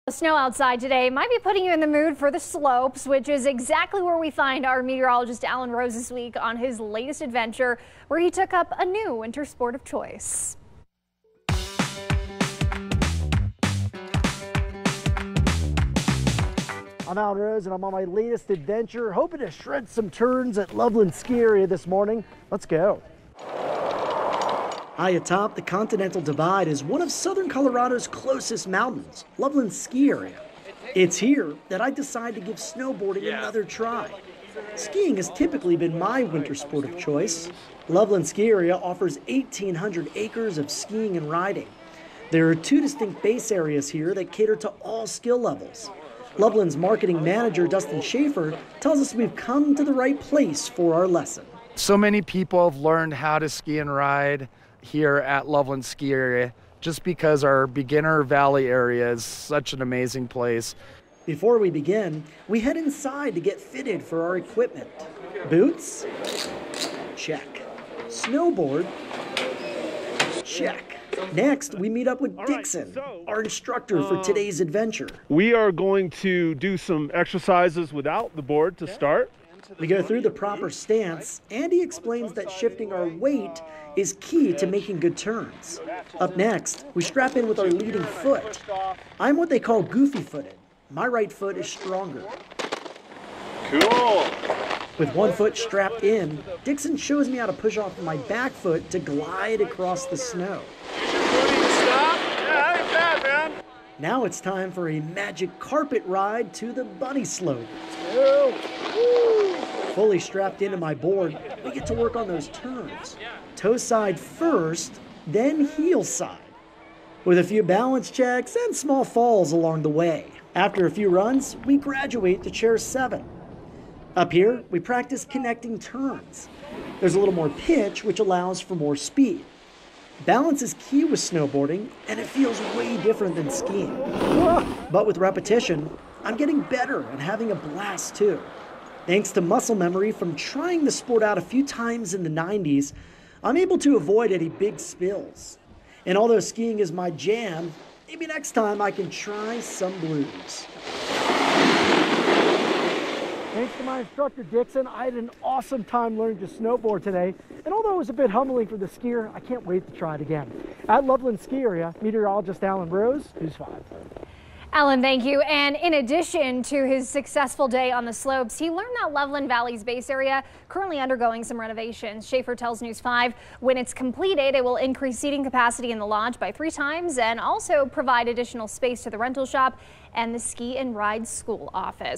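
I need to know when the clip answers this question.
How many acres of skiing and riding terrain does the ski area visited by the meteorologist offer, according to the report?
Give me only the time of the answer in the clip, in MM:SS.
00:39.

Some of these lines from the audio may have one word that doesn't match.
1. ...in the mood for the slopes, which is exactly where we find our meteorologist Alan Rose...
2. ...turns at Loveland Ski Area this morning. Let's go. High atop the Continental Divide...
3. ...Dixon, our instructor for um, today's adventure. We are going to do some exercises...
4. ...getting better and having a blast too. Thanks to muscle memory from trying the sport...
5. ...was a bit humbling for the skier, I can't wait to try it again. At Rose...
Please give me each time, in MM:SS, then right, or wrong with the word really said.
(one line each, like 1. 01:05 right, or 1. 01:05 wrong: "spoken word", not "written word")
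1. 00:01 right
2. 00:20 right
3. 01:12 right
4. 02:16 right
5. 02:37 wrong: "Loveland", not "Rose".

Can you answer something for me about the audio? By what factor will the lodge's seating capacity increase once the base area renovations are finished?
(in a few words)
3 times.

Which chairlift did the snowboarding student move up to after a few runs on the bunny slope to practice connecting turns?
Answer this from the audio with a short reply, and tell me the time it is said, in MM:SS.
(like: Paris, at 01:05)
Chair 7, at 02:02.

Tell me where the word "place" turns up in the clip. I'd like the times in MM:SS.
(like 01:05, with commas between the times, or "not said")
00:50, 01:00.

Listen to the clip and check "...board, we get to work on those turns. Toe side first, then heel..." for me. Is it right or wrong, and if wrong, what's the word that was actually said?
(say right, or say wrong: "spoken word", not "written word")
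right.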